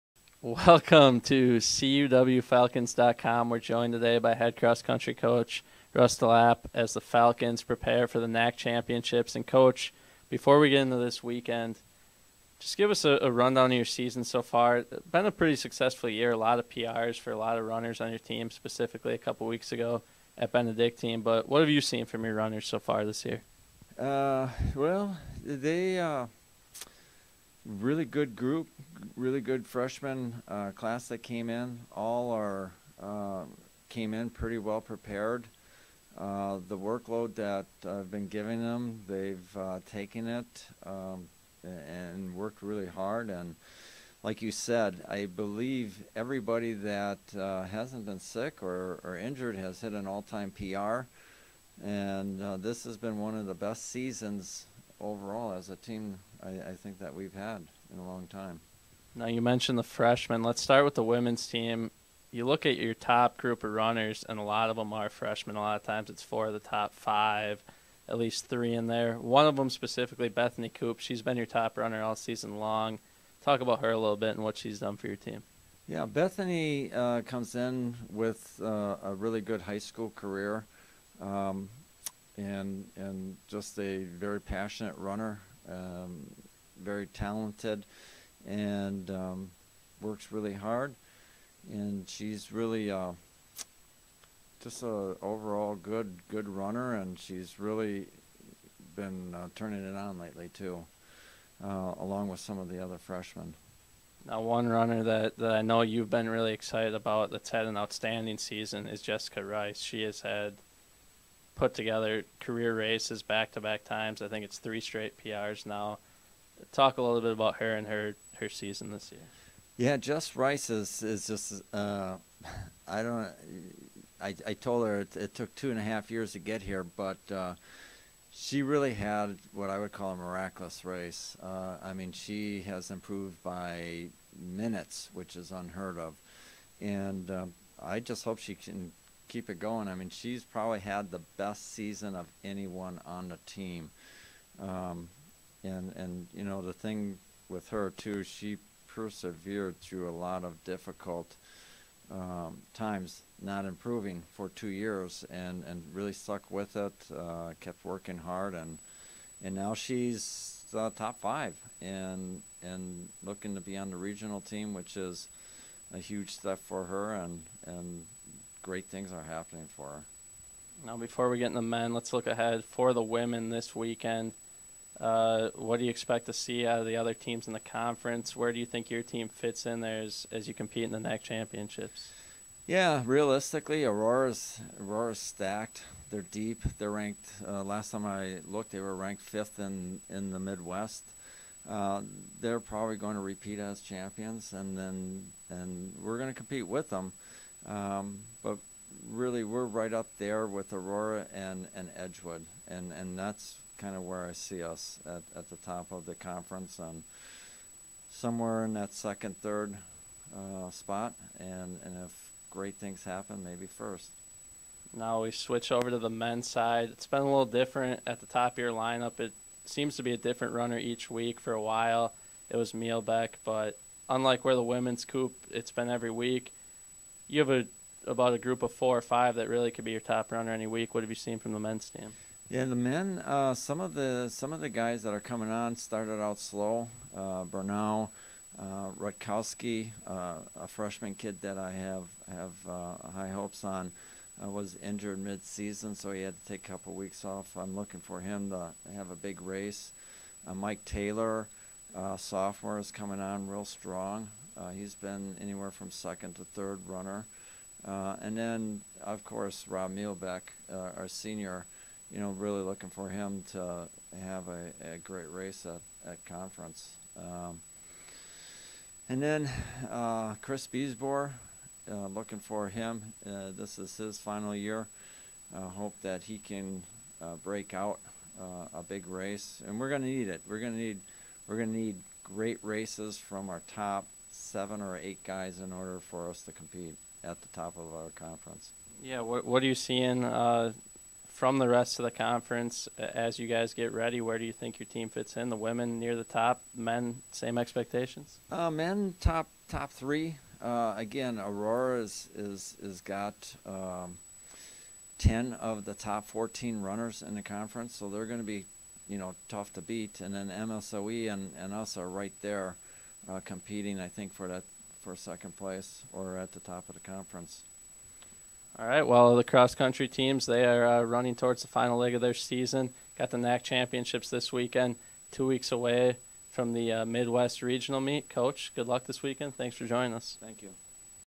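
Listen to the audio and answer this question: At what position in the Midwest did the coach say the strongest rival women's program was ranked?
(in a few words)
5th.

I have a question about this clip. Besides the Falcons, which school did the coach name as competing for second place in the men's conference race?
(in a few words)
MSOE.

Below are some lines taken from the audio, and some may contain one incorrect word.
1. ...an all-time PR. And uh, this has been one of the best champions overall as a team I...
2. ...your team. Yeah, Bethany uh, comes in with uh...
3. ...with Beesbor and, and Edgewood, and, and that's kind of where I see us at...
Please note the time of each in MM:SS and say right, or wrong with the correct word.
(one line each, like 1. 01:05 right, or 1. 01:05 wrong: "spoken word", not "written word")
1. 00:49 wrong: "seasons", not "champions"
2. 01:15 right
3. 03:20 wrong: "Aurora", not "Beesbor".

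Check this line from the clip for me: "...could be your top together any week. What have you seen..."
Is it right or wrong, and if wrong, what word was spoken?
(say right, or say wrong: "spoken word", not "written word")
wrong: "runner", not "together".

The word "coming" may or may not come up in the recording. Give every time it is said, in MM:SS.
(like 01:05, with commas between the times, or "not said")
03:55, 04:12.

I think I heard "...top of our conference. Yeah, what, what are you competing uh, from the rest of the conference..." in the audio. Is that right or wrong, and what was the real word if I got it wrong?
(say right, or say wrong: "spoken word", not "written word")
wrong: "seeing", not "competing".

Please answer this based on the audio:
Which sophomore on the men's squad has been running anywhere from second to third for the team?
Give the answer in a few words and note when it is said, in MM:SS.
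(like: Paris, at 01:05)
Mike Taylor, at 04:10.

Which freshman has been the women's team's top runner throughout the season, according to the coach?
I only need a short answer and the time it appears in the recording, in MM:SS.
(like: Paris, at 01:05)
Bethany Coop, at 01:10.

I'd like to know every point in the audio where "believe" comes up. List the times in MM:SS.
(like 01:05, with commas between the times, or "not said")
00:45.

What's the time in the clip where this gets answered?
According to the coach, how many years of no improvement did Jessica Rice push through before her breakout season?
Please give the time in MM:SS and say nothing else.
02:34.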